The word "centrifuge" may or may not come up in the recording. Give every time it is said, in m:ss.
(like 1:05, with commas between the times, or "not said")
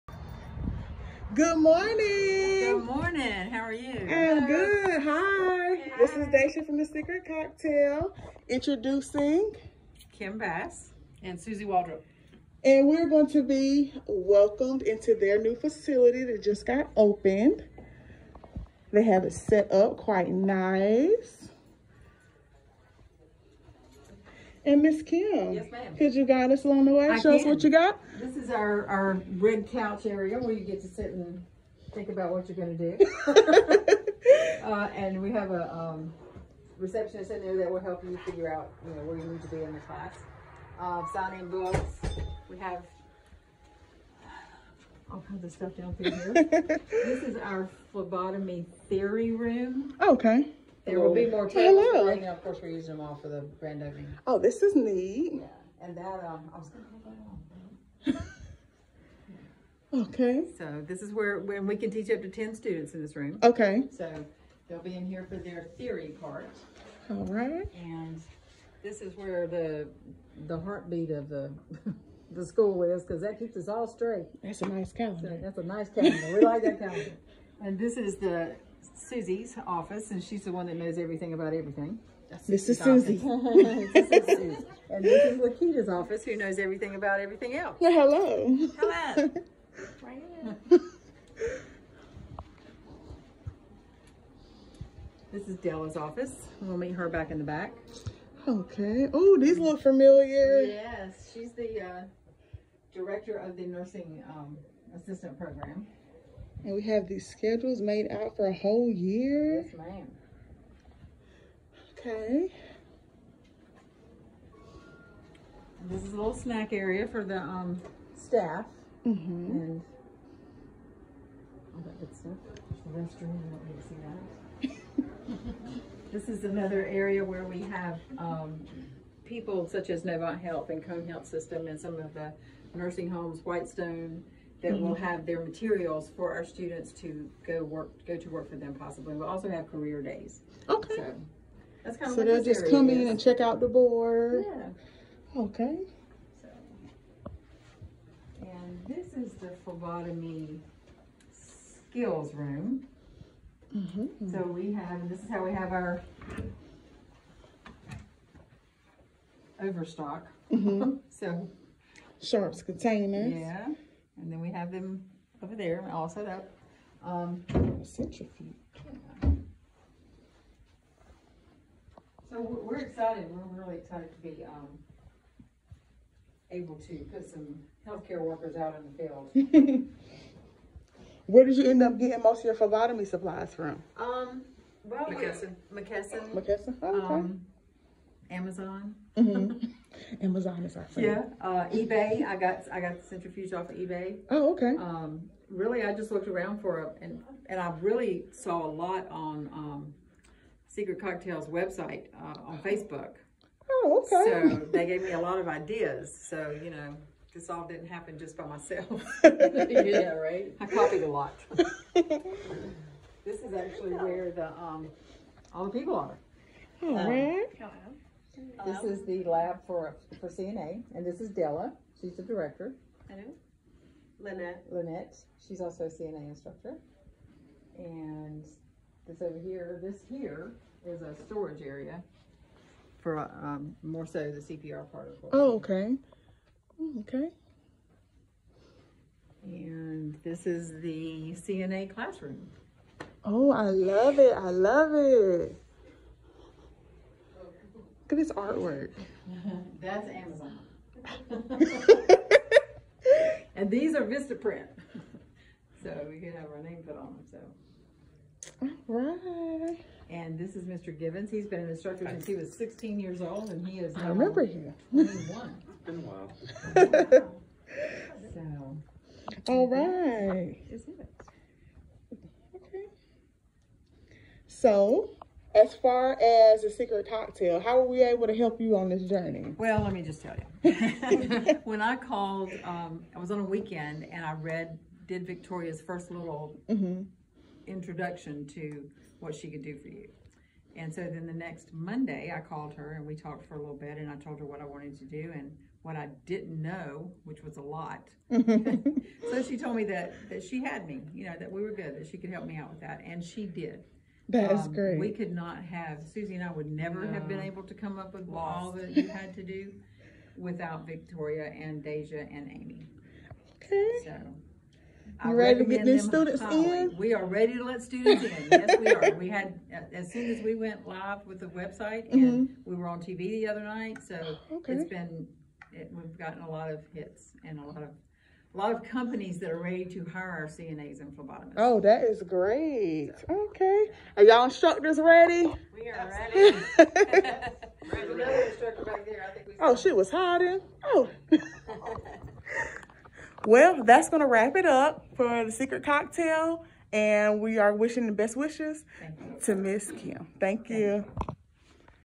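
2:47, 3:13.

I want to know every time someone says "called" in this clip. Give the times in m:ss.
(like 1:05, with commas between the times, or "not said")
4:41, 4:52.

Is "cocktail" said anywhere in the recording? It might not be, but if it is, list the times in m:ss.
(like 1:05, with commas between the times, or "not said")
0:07, 3:21, 4:37, 5:45.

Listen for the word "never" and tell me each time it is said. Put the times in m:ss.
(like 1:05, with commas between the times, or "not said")
5:06.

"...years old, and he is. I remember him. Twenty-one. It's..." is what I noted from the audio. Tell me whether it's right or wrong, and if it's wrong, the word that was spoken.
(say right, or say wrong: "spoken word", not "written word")
right.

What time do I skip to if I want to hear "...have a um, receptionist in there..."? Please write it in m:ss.
0:35.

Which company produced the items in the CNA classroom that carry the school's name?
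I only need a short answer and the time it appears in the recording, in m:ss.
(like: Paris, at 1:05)
Vistaprint, at 4:14.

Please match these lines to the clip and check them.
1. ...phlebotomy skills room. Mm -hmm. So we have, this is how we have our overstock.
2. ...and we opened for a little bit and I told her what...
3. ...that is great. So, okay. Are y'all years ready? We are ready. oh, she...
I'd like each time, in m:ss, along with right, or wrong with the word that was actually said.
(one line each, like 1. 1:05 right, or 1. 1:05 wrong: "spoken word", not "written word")
1. 2:29 right
2. 4:52 wrong: "talked", not "opened"
3. 5:31 wrong: "instructors", not "years".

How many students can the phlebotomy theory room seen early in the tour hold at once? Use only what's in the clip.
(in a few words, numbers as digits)
10.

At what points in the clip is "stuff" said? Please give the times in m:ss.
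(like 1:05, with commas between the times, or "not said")
0:45, 2:02.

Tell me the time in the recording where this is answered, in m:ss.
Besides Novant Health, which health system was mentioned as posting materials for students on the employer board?
2:10.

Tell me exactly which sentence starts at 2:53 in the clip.
We're really excited to be um, able to put some healthcare workers out in the field.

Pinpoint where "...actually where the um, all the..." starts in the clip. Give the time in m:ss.
3:33.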